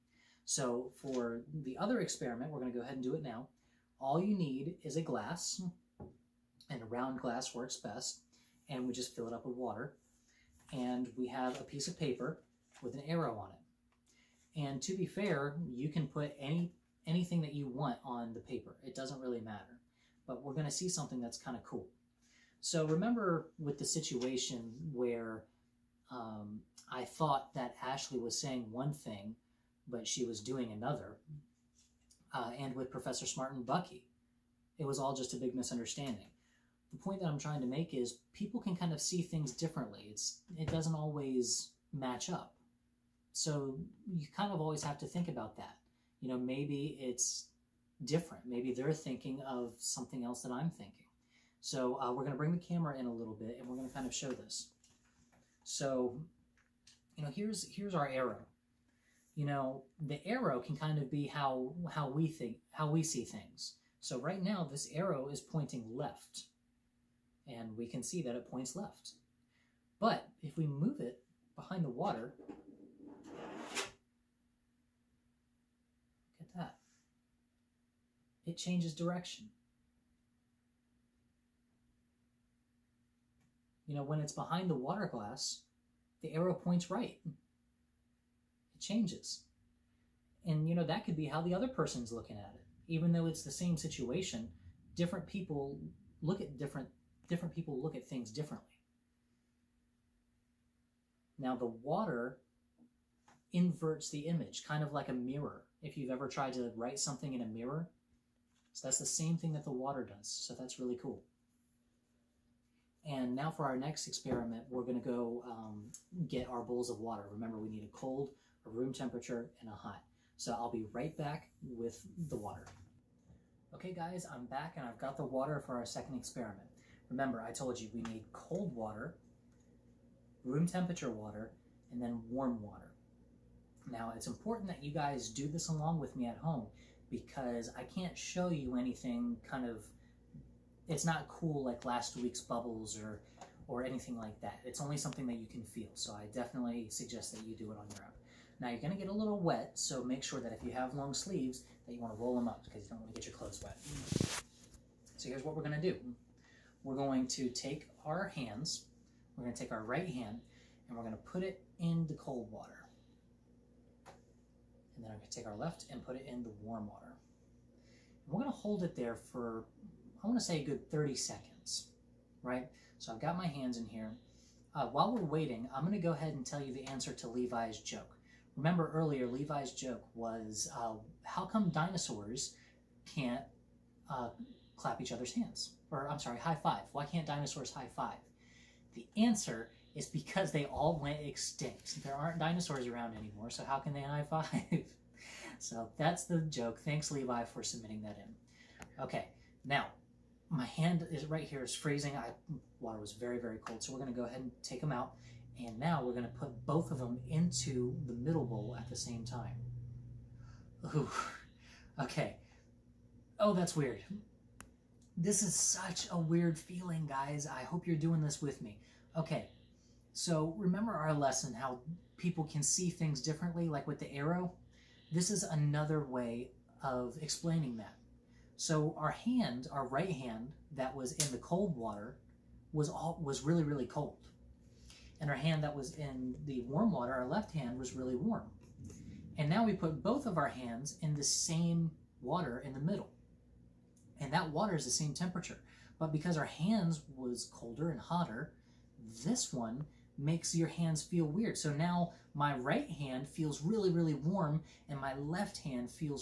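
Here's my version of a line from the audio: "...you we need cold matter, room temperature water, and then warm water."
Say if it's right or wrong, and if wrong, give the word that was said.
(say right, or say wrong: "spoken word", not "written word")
wrong: "water", not "matter".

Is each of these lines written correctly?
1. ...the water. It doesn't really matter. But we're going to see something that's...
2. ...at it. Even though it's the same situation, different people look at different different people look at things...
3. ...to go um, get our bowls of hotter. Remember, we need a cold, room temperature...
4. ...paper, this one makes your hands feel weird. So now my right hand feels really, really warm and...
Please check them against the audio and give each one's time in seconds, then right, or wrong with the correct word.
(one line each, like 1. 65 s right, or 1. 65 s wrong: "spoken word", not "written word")
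1. 18 s wrong: "paper", not "water"
2. 92 s right
3. 115 s wrong: "water", not "hotter"
4. 248 s wrong: "hotter", not "paper".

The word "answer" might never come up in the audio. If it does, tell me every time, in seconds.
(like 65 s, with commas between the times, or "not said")
176 s, 189 s.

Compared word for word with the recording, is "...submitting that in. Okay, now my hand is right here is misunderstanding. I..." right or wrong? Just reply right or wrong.
wrong.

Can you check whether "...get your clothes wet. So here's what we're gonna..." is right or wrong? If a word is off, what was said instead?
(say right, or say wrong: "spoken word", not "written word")
right.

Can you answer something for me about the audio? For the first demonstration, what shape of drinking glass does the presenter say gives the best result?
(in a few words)
Round.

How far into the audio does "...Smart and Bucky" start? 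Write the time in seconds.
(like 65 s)
33 s.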